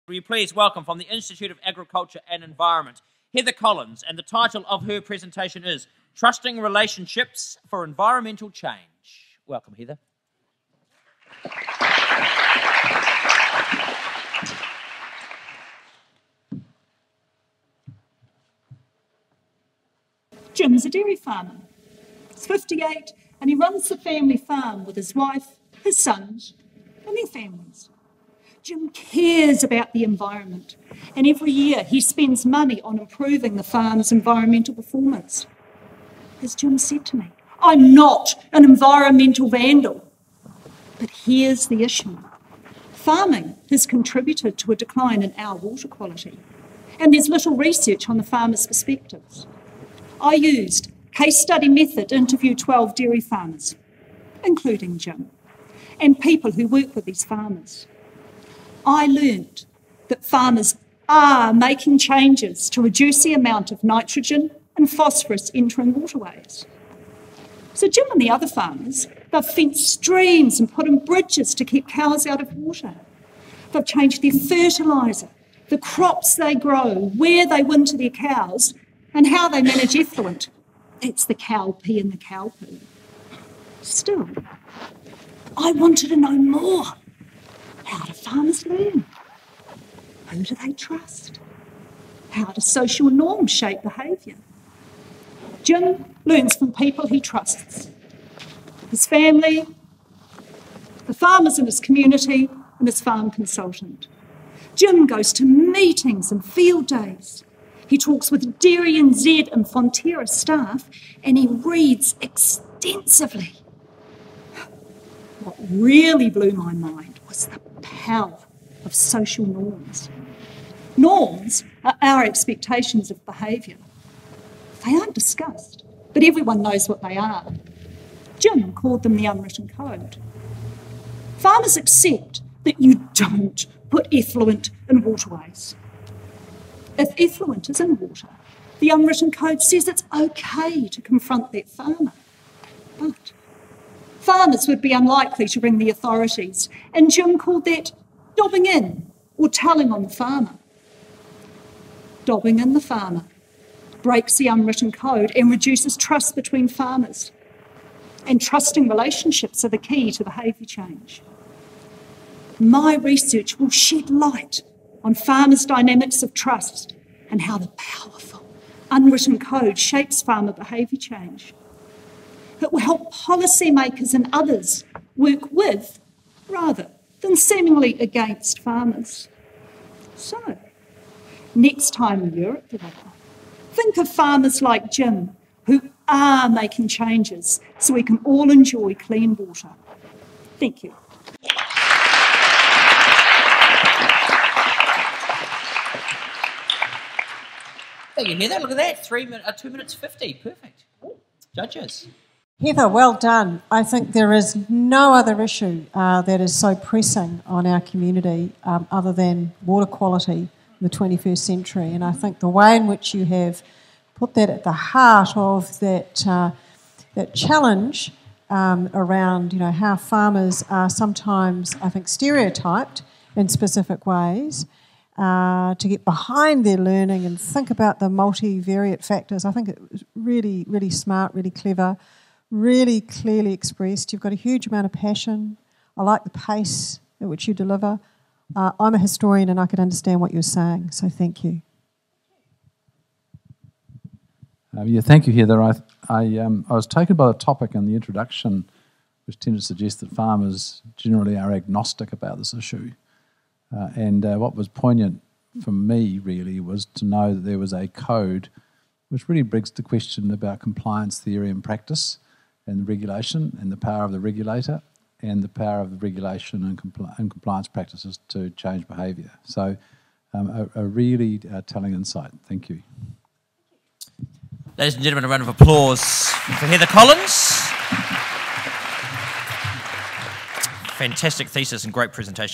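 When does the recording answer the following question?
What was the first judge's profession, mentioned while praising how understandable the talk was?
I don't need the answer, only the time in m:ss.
3:58.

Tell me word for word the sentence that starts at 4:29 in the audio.
So, um, a, a, really uh, telling insight.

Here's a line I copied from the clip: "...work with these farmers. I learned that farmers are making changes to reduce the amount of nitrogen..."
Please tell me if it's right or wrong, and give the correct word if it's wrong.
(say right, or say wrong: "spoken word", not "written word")
right.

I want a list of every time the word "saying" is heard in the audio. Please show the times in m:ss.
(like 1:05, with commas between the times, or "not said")
4:00.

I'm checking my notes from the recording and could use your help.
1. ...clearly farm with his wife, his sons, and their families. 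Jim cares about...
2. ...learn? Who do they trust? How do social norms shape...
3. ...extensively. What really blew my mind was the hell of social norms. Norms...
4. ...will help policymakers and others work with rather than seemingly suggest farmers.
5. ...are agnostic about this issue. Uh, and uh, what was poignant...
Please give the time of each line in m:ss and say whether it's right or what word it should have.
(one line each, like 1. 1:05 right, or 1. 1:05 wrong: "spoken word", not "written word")
1. 0:23 wrong: "family", not "clearly"
2. 1:28 right
3. 1:52 right
4. 2:52 wrong: "against", not "suggest"
5. 4:11 right.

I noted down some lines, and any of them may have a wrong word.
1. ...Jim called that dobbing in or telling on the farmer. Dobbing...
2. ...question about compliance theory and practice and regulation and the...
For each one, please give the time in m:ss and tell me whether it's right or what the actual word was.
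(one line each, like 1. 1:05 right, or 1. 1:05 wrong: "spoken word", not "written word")
1. 2:27 right
2. 4:19 right.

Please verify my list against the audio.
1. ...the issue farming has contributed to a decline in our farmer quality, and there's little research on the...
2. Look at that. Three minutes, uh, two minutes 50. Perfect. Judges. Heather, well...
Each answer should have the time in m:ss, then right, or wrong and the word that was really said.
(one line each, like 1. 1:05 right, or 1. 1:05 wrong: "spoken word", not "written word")
1. 0:41 wrong: "water", not "farmer"
2. 3:18 right.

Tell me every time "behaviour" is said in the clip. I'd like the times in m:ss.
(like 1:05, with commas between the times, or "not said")
1:33, 2:03, 2:40, 2:50, 4:28.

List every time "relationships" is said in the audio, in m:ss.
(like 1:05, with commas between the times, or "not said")
0:06, 2:38.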